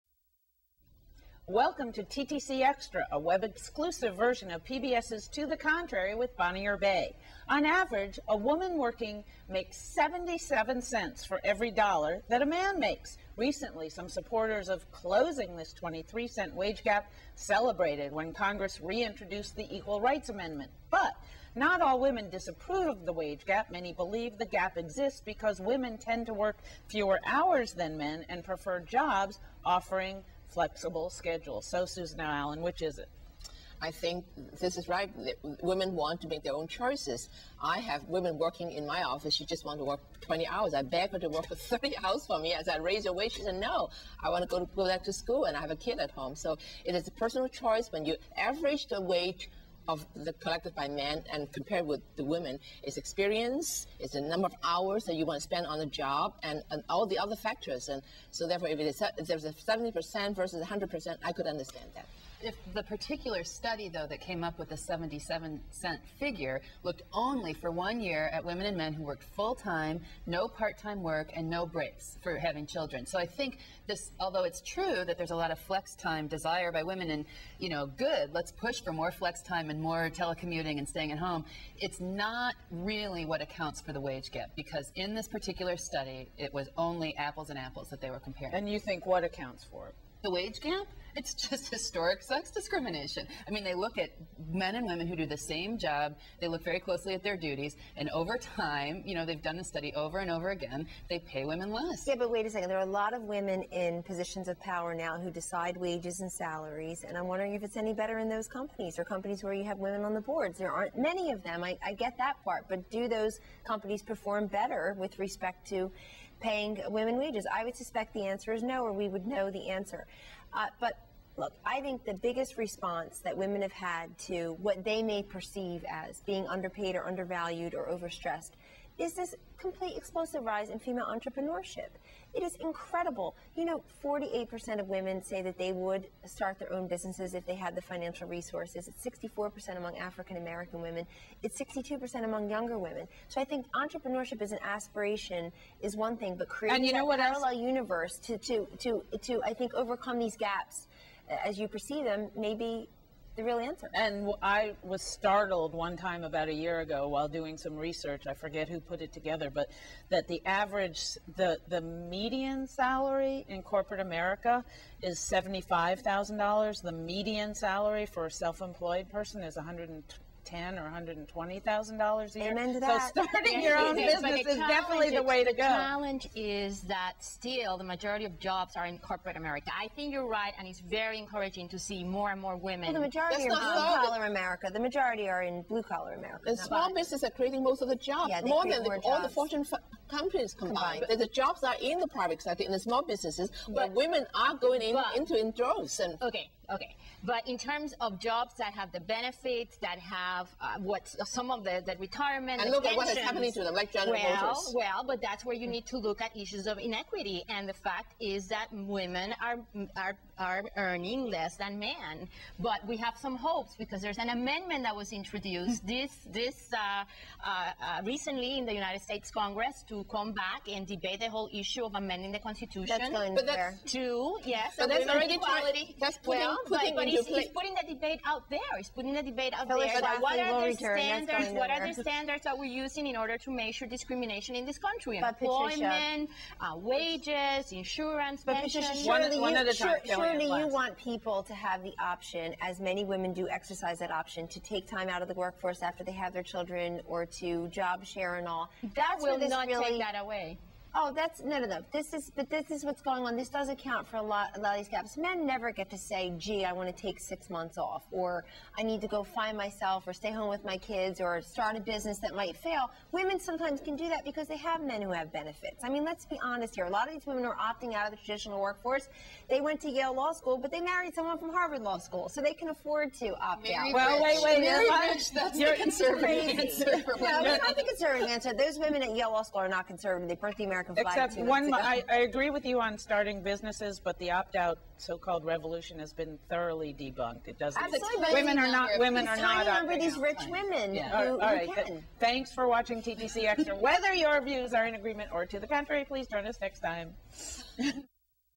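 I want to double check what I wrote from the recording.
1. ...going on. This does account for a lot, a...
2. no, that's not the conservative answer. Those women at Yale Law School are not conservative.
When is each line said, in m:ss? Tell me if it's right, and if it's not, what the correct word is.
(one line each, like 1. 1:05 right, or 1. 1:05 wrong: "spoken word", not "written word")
1. 4:13 right
2. 4:37 right.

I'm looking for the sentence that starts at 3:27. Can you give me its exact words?
And the fact is that women are are are earning less than men.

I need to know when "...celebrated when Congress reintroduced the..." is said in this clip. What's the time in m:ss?
0:17.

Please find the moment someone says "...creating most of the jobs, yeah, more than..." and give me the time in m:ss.
3:07.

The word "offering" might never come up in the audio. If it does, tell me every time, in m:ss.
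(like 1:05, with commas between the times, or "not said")
0:29.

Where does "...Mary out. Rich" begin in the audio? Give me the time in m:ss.
4:33.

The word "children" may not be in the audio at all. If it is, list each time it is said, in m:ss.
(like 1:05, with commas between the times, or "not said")
1:12, 4:06.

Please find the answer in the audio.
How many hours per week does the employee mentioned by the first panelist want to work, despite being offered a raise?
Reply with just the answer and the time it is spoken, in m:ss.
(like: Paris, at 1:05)
20, at 0:40.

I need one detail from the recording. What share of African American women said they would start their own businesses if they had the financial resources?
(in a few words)
64%.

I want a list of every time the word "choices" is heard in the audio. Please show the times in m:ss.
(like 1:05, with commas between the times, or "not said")
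0:36, 0:47.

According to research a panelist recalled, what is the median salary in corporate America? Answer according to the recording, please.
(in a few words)
$75,000.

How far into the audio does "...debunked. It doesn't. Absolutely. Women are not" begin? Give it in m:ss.
4:46.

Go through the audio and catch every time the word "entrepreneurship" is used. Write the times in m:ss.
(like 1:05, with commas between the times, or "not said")
2:11, 2:23.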